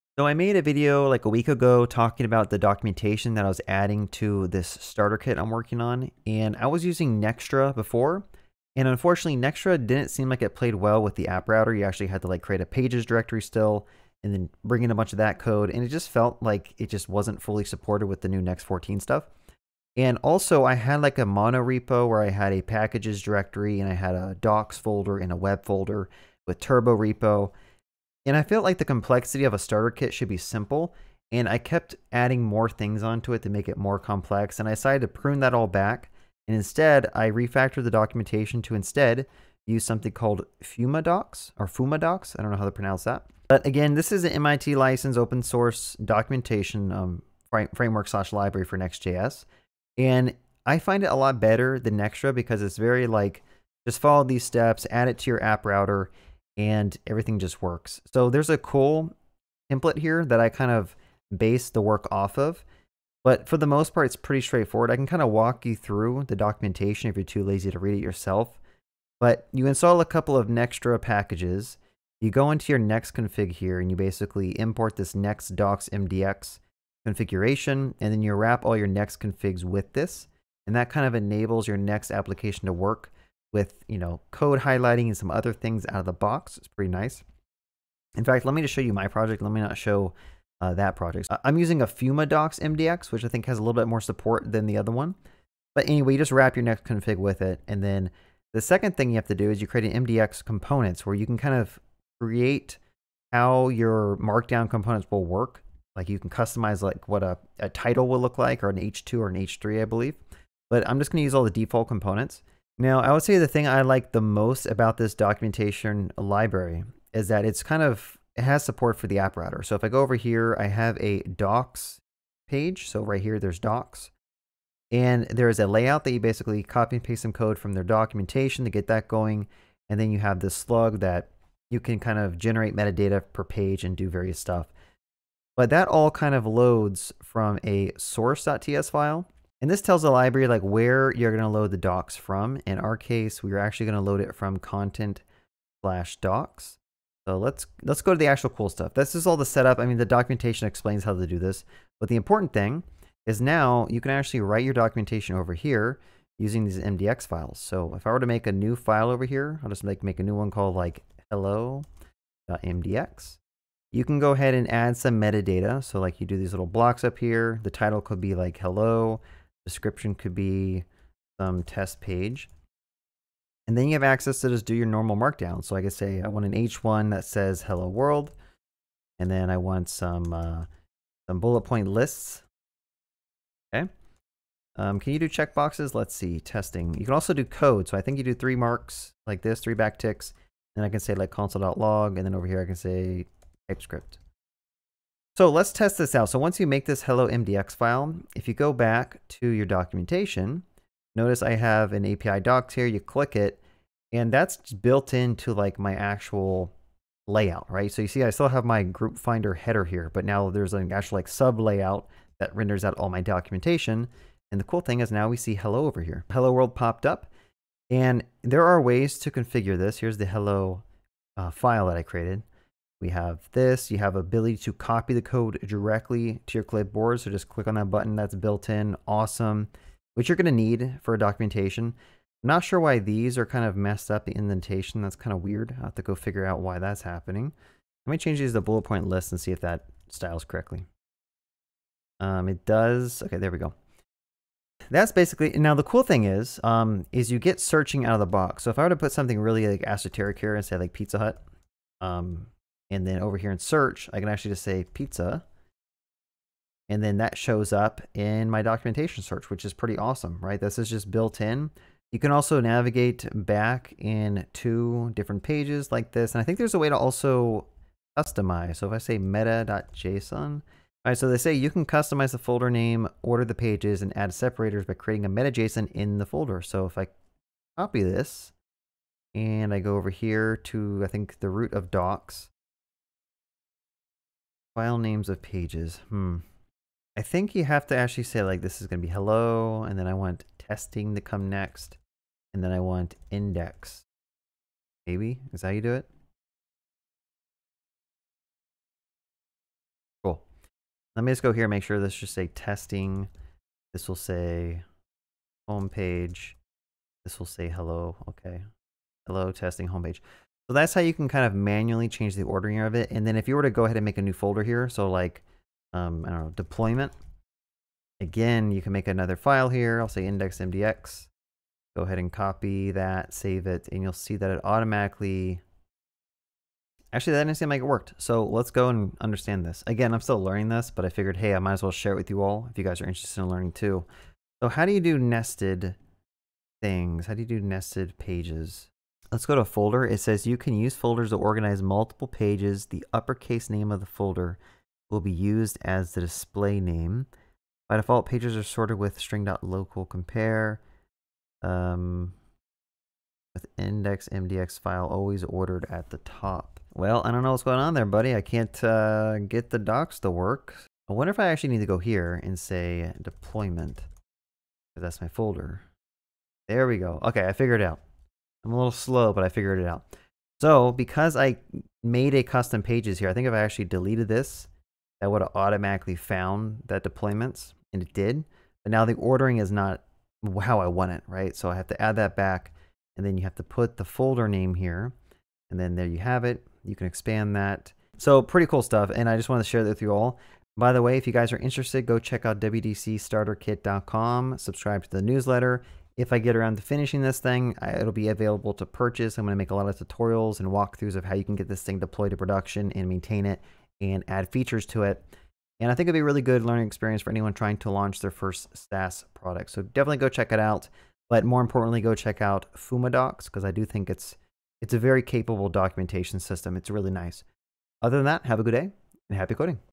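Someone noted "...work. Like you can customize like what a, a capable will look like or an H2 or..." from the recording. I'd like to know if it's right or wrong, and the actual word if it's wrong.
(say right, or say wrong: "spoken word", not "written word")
wrong: "title", not "capable".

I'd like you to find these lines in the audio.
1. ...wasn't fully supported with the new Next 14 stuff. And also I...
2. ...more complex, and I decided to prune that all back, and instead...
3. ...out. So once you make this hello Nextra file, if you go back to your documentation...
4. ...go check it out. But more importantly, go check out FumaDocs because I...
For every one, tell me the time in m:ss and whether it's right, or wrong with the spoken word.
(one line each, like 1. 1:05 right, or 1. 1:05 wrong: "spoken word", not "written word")
1. 0:17 right
2. 0:33 right
3. 3:16 wrong: "MDX", not "Nextra"
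4. 6:50 right.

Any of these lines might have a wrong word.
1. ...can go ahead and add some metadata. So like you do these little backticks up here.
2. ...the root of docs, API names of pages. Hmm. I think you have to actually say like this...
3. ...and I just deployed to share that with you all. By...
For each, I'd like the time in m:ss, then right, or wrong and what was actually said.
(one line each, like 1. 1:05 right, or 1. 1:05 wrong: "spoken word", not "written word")
1. 2:44 wrong: "blocks", not "backticks"
2. 4:41 wrong: "File", not "API"
3. 6:29 wrong: "wanted", not "deployed".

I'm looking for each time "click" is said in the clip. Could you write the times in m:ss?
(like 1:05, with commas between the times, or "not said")
3:22, 3:47.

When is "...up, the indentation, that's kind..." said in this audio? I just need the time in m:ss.
3:54.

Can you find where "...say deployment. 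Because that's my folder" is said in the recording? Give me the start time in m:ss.
6:02.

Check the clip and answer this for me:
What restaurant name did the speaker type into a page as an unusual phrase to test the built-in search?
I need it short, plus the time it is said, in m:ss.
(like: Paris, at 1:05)
Pizza Hut, at 4:10.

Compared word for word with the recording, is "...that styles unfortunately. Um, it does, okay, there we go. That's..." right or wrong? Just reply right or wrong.
wrong.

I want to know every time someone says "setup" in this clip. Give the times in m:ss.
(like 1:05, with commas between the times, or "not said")
2:29.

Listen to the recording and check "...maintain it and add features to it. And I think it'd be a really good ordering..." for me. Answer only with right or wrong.
wrong.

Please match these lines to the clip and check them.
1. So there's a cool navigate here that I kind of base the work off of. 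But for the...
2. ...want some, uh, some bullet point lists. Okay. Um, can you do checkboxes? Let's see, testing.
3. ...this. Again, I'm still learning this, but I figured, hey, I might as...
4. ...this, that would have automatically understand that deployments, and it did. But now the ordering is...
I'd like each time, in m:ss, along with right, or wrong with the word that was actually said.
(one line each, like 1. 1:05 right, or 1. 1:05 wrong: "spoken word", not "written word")
1. 0:58 wrong: "template", not "navigate"
2. 2:59 right
3. 5:29 right
4. 6:14 wrong: "found", not "understand".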